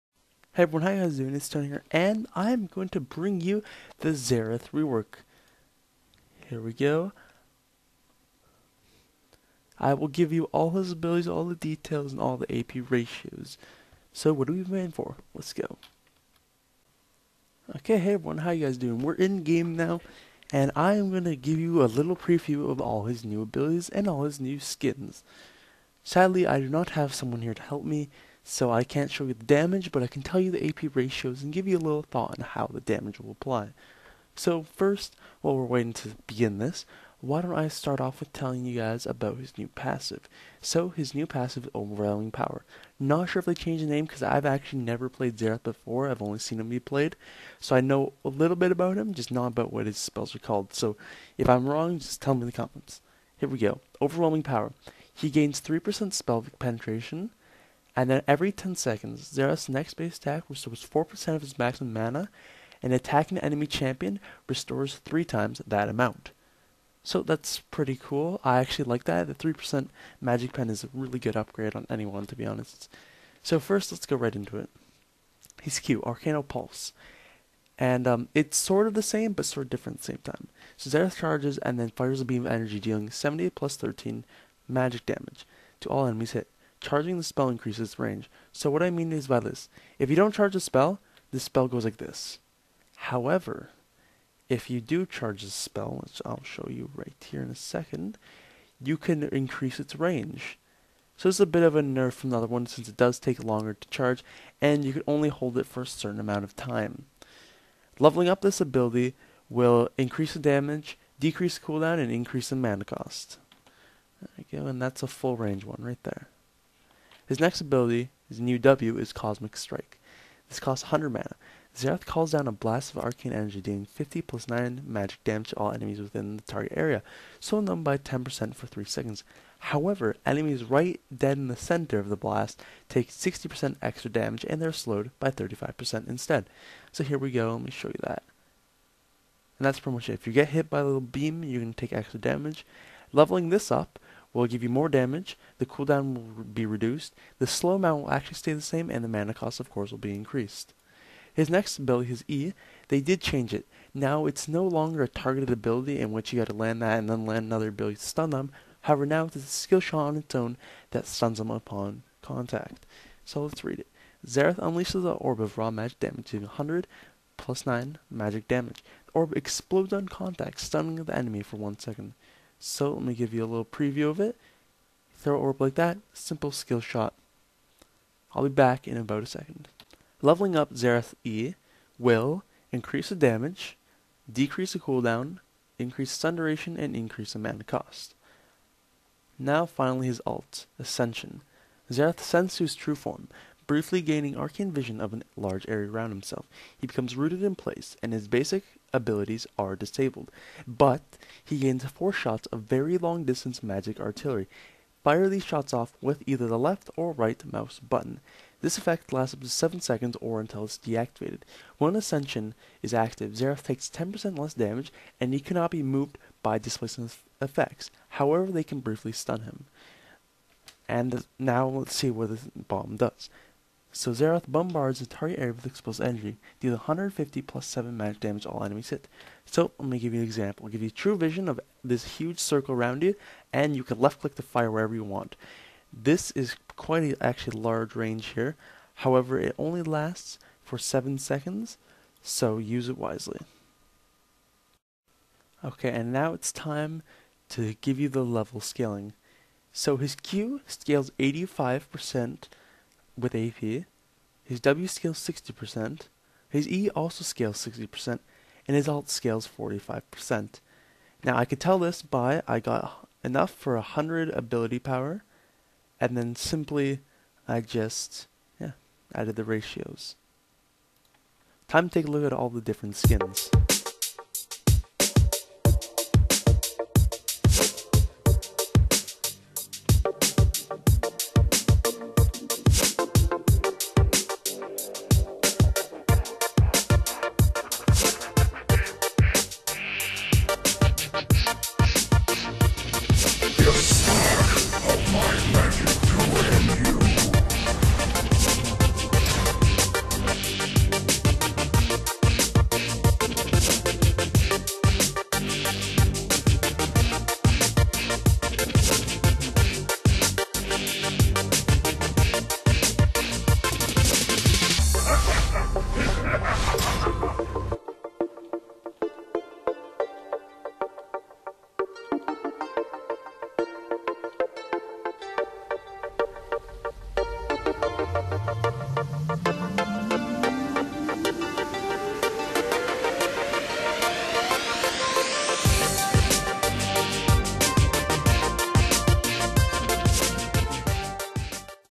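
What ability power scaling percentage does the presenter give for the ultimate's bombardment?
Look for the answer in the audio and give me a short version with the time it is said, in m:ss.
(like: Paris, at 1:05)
45%, at 4:19.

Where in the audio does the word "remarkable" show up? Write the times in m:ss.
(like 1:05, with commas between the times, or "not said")
not said.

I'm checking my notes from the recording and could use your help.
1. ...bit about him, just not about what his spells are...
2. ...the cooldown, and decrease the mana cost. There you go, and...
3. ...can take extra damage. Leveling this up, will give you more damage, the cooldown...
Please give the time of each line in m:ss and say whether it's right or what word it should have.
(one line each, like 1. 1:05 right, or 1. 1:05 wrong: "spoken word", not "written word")
1. 0:48 right
2. 1:51 wrong: "increase", not "decrease"
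3. 2:21 right.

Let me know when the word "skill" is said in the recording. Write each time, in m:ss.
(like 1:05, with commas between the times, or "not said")
2:39, 2:56.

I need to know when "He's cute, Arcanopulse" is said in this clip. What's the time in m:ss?
1:15.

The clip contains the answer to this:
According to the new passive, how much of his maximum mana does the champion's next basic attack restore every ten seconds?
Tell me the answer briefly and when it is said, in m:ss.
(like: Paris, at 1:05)
4%, at 1:00.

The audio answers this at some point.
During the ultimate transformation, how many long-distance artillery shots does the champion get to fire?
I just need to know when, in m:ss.
3:21.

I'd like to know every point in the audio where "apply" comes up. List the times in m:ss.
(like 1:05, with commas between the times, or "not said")
0:33.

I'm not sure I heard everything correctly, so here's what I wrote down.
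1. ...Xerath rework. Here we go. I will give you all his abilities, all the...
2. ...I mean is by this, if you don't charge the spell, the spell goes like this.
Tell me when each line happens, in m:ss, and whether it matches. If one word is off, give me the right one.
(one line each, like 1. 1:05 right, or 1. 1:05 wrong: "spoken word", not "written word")
1. 0:04 right
2. 1:28 right.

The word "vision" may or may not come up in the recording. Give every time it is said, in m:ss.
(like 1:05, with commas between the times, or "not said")
3:14, 3:51.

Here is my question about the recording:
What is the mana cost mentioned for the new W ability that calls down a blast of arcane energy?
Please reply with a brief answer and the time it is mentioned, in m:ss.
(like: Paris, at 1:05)
100 mana, at 2:00.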